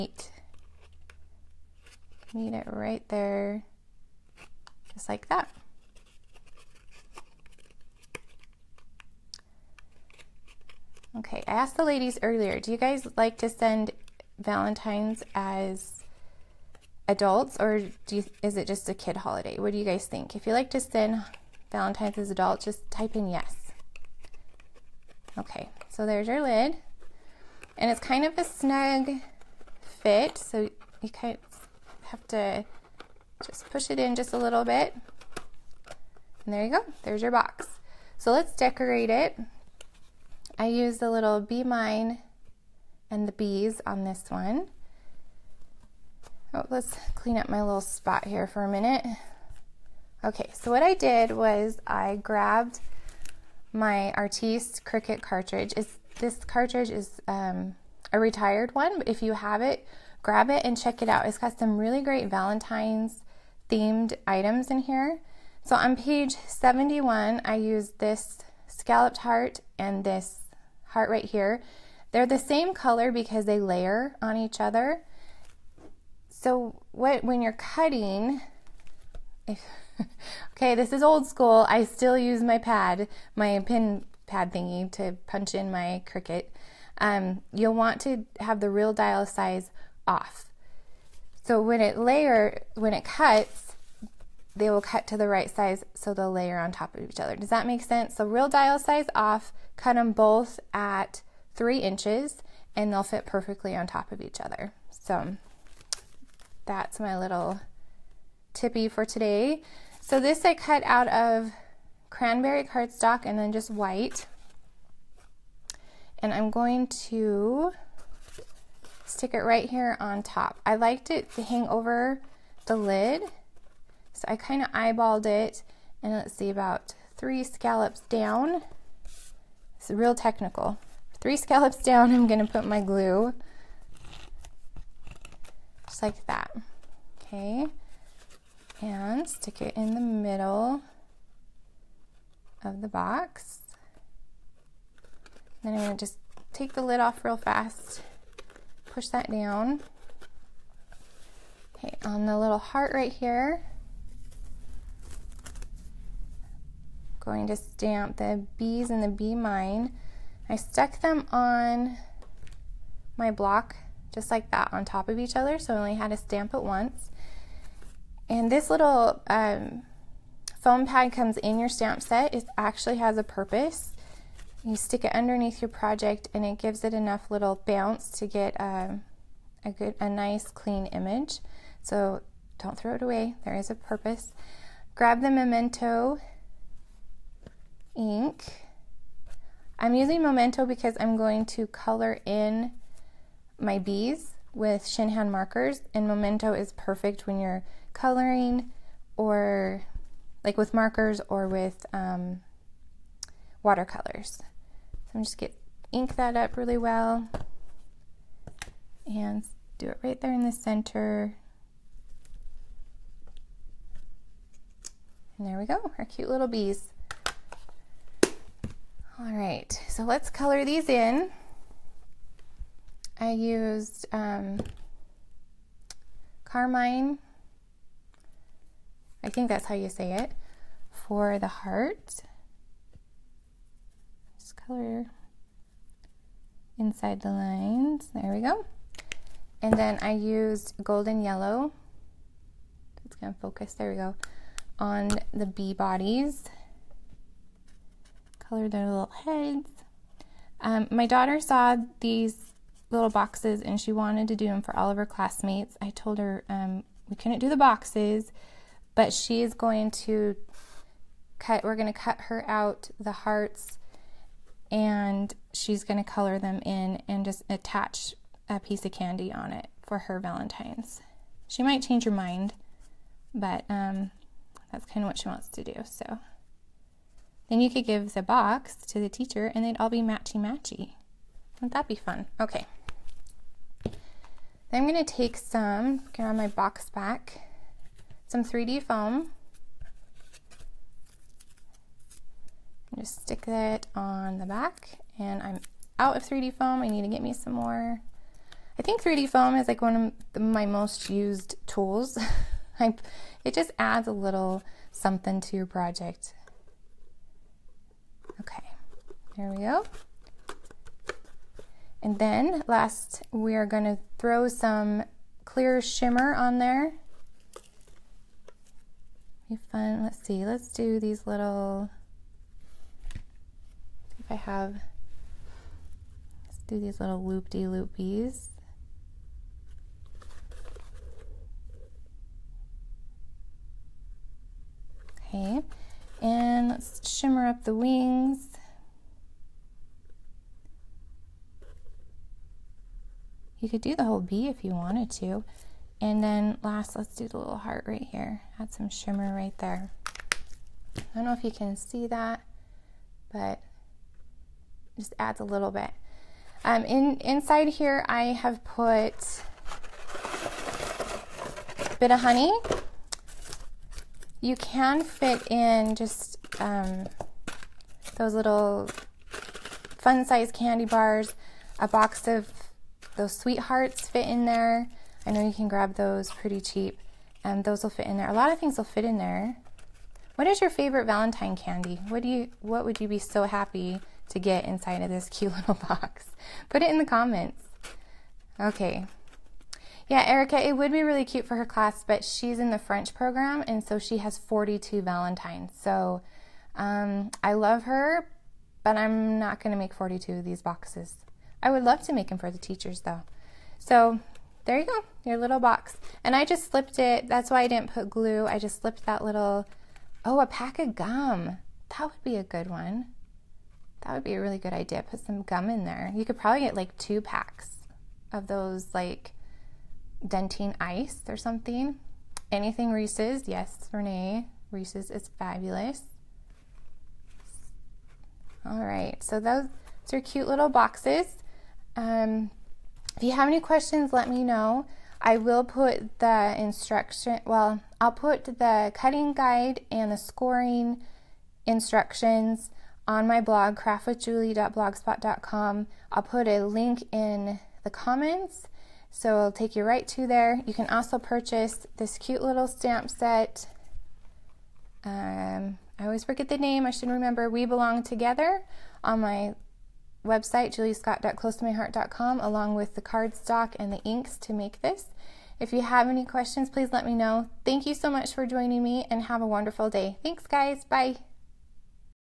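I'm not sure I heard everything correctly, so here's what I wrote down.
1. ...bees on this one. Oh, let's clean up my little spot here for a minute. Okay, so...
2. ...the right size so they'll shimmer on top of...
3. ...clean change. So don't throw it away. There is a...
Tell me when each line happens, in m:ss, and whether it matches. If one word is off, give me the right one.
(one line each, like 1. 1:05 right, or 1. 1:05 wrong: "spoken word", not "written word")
1. 0:43 right
2. 1:35 wrong: "layer", not "shimmer"
3. 3:00 wrong: "image", not "change".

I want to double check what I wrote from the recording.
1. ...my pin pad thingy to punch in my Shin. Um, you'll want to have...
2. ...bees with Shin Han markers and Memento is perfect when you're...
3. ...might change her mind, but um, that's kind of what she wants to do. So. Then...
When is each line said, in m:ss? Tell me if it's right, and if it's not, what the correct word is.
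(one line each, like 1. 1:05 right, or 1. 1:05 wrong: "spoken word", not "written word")
1. 1:23 wrong: "Cricut", not "Shin"
2. 3:13 right
3. 4:31 right.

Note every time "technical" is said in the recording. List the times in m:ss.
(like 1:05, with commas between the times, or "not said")
2:10.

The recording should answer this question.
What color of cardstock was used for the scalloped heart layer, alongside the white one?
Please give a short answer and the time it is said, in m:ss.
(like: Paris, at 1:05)
cranberry, at 1:52.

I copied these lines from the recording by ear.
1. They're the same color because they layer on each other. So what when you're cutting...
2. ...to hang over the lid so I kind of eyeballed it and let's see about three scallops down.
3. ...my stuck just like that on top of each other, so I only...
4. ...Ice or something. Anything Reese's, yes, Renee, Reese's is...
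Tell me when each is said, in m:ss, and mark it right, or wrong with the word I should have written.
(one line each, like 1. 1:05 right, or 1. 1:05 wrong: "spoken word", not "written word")
1. 1:12 right
2. 2:01 right
3. 2:43 wrong: "block", not "stuck"
4. 7:00 right.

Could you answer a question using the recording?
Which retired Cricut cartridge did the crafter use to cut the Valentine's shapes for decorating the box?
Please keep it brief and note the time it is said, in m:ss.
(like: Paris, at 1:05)
Artiste, at 0:54.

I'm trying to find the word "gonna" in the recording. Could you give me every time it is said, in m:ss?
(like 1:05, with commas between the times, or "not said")
2:12, 2:25, 3:25, 5:13.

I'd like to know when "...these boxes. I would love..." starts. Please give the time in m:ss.
6:40.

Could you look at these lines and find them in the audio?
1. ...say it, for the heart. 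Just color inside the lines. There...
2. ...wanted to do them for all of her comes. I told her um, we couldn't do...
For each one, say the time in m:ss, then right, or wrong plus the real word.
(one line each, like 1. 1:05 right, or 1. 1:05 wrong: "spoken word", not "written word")
1. 3:49 right
2. 4:13 wrong: "classmates", not "comes".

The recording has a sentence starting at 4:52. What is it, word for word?
Just stick that on the back and I'm out of 3D foam.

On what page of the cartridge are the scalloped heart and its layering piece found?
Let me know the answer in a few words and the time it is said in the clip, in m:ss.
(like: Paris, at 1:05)
71, at 1:06.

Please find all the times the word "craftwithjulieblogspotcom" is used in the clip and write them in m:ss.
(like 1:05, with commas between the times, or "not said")
7:23.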